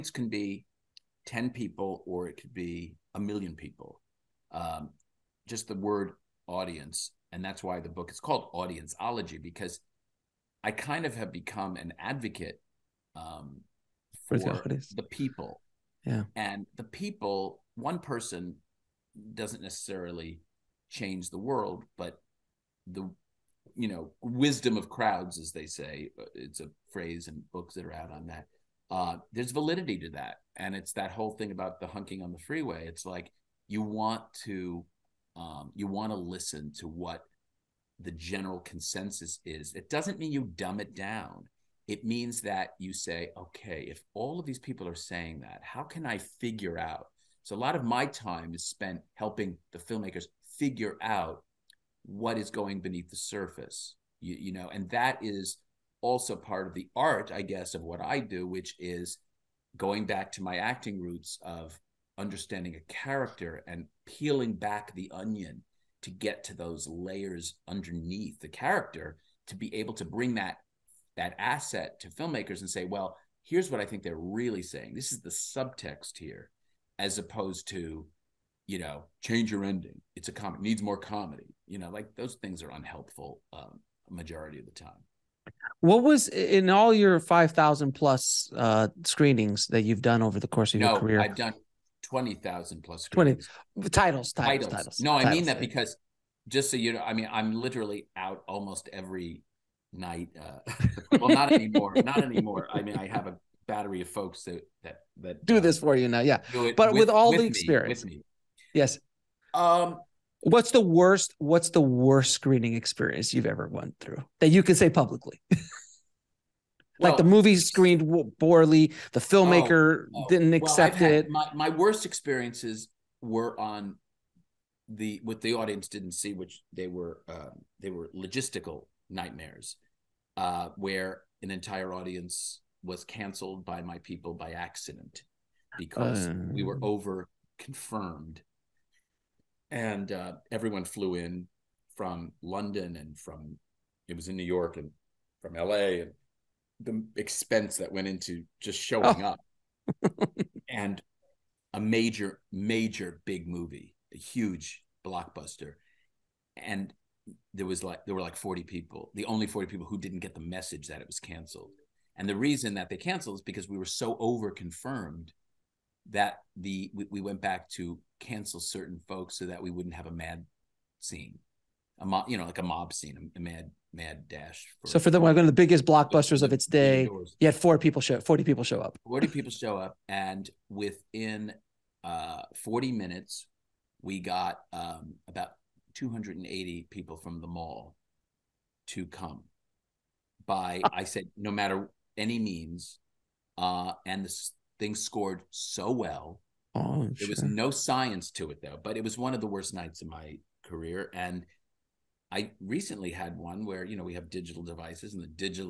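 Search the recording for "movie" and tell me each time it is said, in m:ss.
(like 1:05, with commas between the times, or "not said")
1:57, 2:33.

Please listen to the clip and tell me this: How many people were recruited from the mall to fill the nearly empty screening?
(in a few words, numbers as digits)
280.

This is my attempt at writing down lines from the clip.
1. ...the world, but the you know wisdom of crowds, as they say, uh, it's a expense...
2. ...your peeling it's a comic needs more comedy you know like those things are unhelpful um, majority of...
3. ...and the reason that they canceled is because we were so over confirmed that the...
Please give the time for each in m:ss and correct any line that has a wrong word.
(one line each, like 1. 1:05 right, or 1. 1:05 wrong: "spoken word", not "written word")
1. 0:21 wrong: "phrase", not "expense"
2. 1:19 wrong: "ending", not "peeling"
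3. 2:42 right.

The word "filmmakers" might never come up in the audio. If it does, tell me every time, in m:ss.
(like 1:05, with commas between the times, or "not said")
0:49, 1:12, 1:59.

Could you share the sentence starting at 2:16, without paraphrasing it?
over confirmed, and uh, everyone flew in from London and from it was in New York and from L.A.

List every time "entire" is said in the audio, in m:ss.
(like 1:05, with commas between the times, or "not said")
2:11.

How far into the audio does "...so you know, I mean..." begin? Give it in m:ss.
1:36.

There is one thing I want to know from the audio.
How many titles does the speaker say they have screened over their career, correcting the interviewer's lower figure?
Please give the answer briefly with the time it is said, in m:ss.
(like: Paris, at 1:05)
20,000 plus, at 1:32.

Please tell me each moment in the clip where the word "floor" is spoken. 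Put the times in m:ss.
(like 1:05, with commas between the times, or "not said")
not said.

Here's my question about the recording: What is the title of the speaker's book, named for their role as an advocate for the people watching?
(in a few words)
Audienceology.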